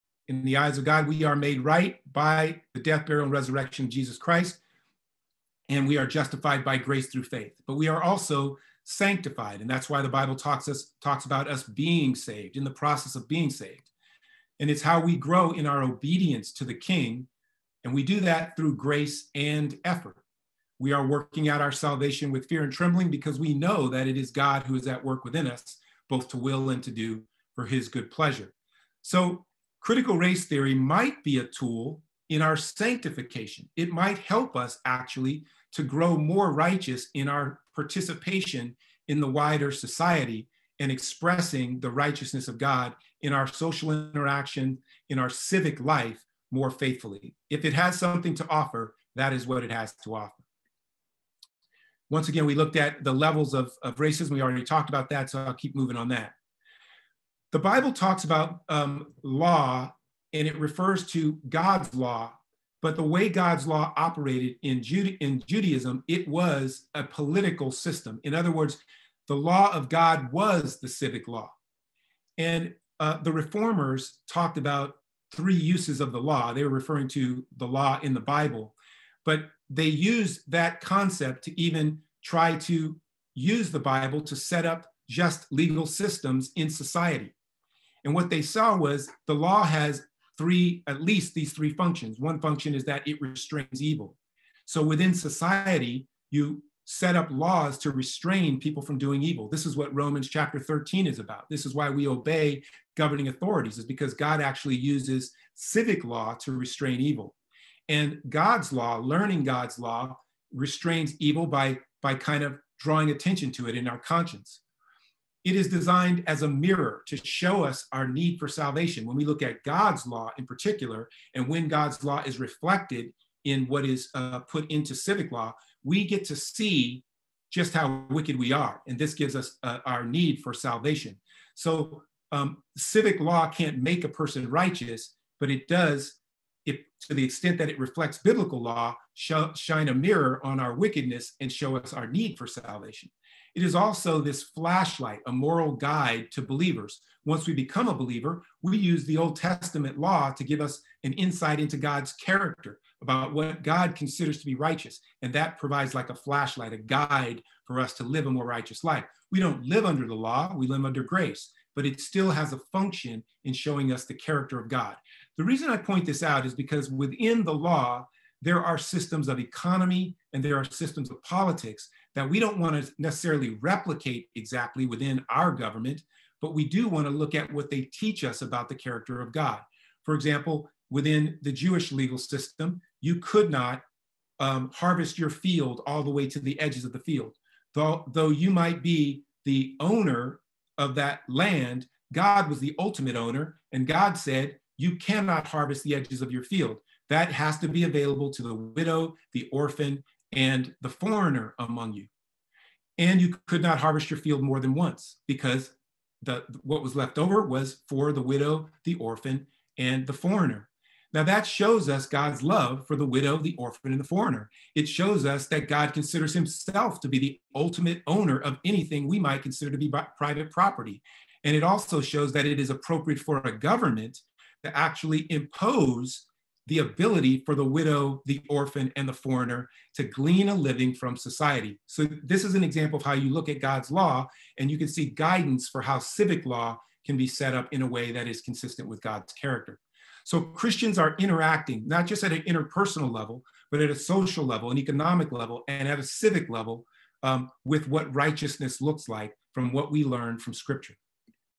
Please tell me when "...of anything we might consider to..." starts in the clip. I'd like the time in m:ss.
3:38.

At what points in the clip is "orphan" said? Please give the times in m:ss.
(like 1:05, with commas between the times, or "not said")
3:19, 3:28, 3:33, 3:48.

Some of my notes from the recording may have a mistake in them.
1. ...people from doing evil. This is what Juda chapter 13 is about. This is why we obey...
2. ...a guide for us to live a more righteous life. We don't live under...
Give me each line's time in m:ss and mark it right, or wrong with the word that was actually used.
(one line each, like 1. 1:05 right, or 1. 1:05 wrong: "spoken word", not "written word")
1. 1:38 wrong: "Romans", not "Juda"
2. 2:36 right.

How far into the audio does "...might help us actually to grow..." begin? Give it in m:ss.
0:33.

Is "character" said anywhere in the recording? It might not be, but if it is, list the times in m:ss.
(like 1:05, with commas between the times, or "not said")
2:32, 2:44, 2:58, 3:59.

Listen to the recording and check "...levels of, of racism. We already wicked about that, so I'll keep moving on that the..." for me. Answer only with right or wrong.
wrong.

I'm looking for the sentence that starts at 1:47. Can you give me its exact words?
And God's law, learning God's law, restrains evil by, by kind of drawing attention to it in our conscience.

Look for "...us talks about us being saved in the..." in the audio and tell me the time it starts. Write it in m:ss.
0:10.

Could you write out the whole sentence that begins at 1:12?
And uh, the reformers talked about three uses of the law.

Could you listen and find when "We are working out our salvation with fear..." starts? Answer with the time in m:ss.
0:20.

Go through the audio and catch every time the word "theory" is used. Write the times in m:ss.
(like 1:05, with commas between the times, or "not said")
0:30.